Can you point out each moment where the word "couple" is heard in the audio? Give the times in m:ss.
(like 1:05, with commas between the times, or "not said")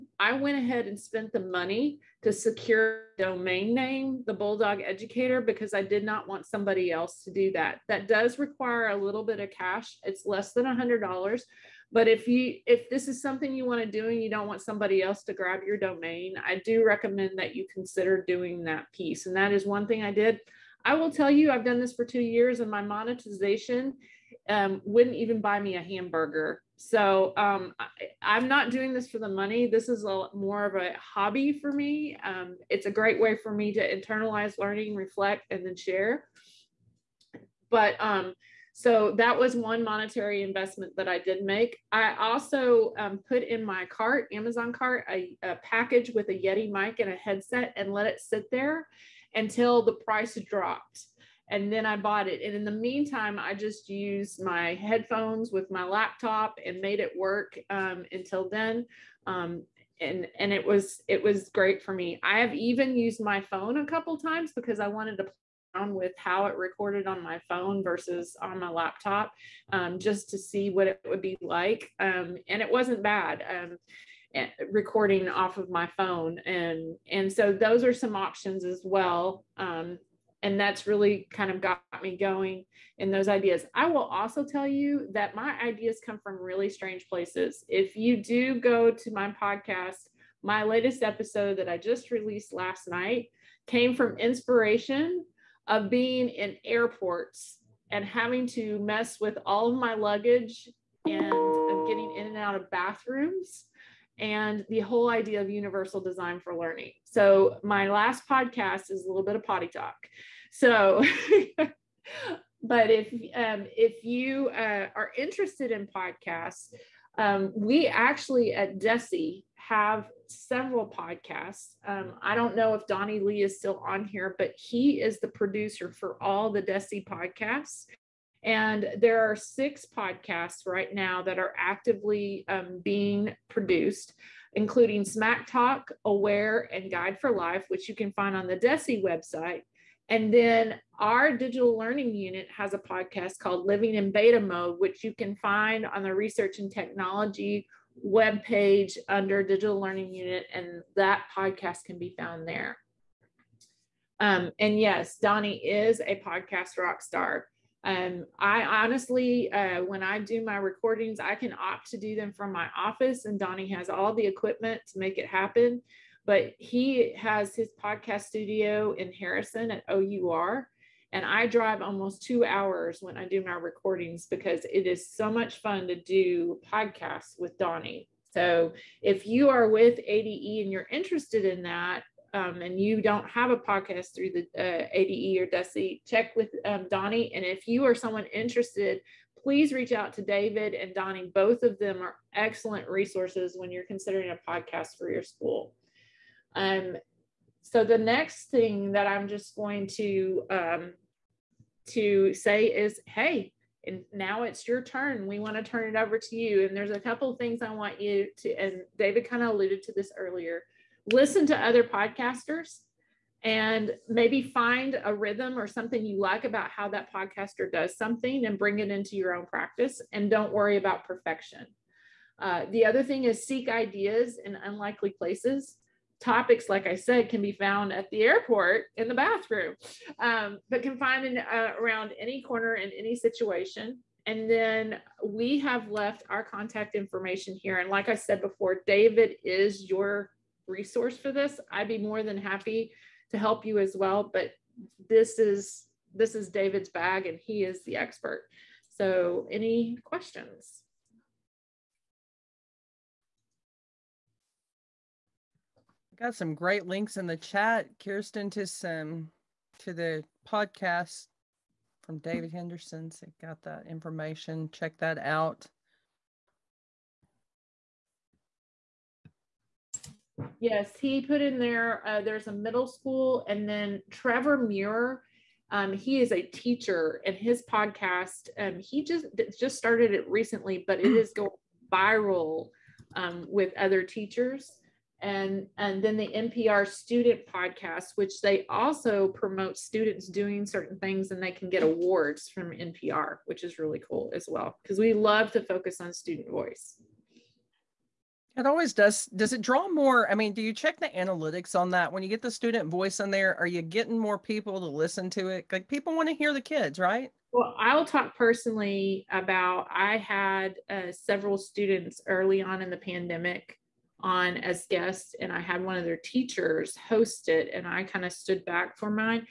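1:03, 3:26.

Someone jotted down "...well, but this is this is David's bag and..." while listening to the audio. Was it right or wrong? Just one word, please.
right.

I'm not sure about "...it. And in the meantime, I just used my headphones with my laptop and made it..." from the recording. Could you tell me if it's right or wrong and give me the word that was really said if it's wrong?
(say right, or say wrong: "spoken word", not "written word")
right.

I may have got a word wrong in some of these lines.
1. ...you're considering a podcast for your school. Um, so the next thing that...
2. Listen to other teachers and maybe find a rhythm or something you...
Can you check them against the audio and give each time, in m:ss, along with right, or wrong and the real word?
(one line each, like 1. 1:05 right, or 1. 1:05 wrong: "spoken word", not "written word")
1. 3:13 right
2. 3:31 wrong: "podcasters", not "teachers".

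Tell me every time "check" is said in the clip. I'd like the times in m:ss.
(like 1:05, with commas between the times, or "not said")
3:06, 4:24, 5:00.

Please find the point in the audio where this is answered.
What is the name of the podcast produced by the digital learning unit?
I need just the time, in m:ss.
2:23.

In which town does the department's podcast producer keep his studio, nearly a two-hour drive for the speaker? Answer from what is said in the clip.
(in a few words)
Harrison.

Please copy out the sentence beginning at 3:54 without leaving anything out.
And then we have left our contact information here.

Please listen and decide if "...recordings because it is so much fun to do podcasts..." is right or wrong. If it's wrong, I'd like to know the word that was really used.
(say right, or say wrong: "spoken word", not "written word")
right.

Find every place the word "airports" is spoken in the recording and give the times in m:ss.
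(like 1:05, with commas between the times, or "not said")
1:36, 3:48.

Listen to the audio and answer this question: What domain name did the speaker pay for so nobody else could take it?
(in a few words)
the Bulldog Educator.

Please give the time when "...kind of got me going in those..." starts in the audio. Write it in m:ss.
1:21.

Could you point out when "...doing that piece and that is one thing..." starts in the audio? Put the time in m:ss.
0:18.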